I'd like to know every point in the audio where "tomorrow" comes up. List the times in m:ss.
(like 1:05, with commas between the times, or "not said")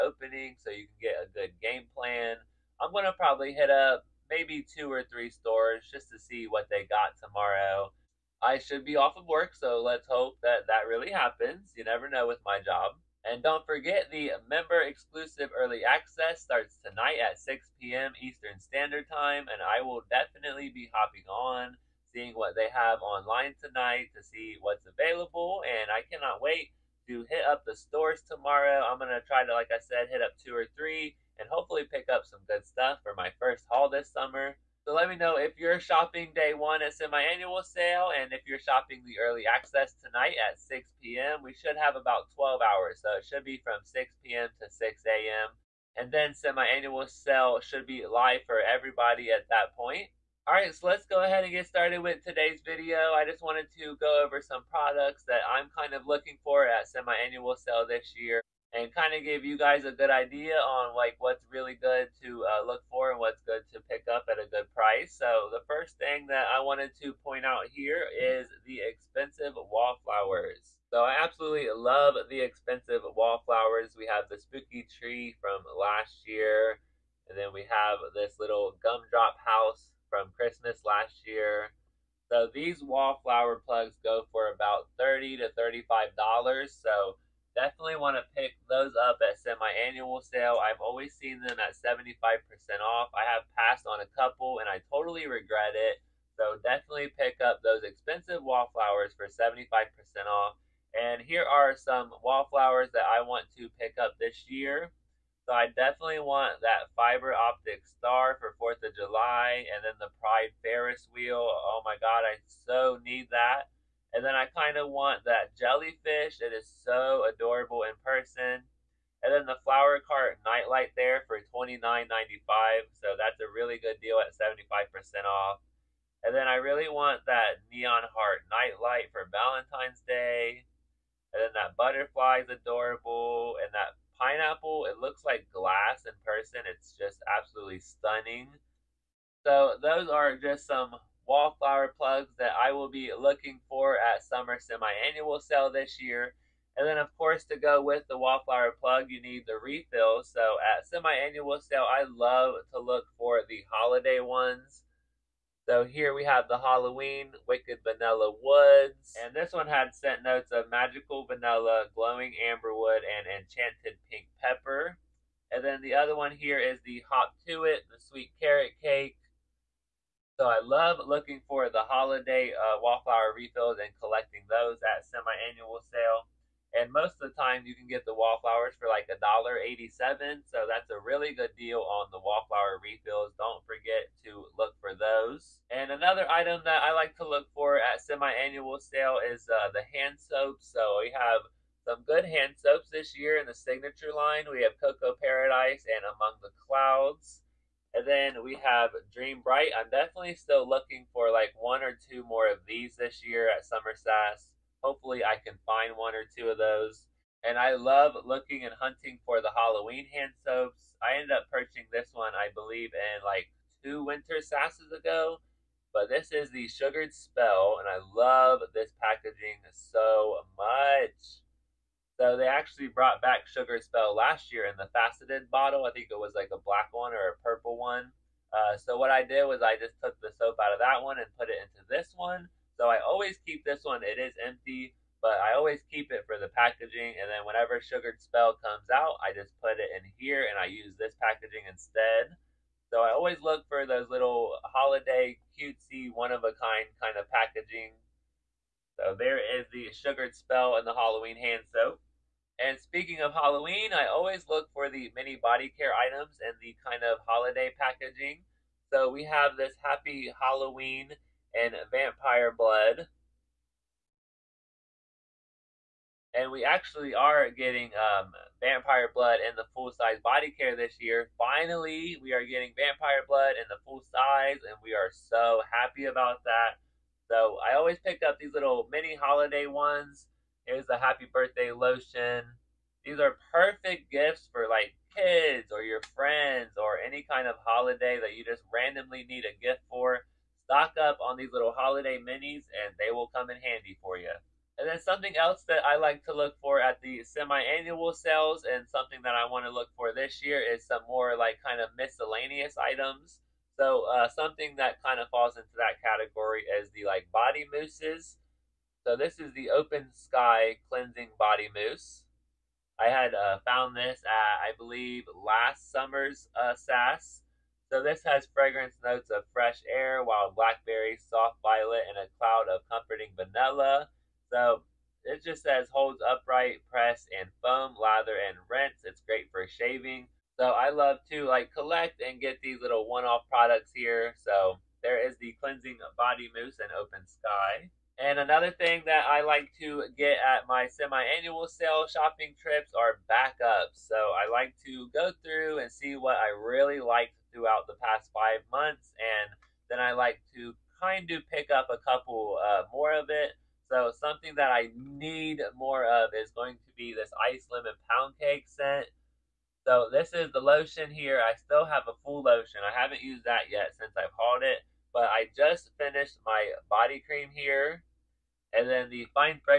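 0:07, 0:28.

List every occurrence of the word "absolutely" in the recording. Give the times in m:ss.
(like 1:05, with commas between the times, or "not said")
1:11, 2:17.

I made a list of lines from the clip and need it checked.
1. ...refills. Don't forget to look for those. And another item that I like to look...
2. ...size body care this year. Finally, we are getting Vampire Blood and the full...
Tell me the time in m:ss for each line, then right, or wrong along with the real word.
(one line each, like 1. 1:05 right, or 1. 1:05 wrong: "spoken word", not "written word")
1. 3:02 right
2. 4:29 right.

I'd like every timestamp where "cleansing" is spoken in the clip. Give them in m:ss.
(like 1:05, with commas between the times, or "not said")
5:10, 5:35.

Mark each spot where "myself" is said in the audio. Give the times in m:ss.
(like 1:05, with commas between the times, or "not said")
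not said.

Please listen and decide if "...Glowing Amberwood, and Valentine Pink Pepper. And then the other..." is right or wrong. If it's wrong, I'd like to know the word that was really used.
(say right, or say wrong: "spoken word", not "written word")
wrong: "Enchanted", not "Valentine".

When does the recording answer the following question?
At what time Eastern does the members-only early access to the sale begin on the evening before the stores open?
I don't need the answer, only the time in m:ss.
0:17.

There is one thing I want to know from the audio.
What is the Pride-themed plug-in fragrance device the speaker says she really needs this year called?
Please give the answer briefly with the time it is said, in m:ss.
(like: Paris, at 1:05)
Pride Ferris wheel, at 1:50.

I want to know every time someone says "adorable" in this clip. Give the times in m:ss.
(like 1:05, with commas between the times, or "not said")
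1:57, 2:12.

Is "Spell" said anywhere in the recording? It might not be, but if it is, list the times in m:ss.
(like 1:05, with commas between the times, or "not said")
3:37, 3:43, 3:58, 4:10.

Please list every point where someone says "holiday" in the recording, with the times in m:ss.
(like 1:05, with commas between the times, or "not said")
2:33, 2:51, 4:04, 4:17, 4:39, 4:47, 4:51.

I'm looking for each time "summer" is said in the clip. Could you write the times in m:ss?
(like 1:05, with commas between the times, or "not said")
0:34, 2:24, 3:23, 5:15.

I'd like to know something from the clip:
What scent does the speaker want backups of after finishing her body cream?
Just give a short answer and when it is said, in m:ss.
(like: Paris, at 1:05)
Ice Lemon Pound Cake, at 5:57.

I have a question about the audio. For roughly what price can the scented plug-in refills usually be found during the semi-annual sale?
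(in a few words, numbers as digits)
$1.87.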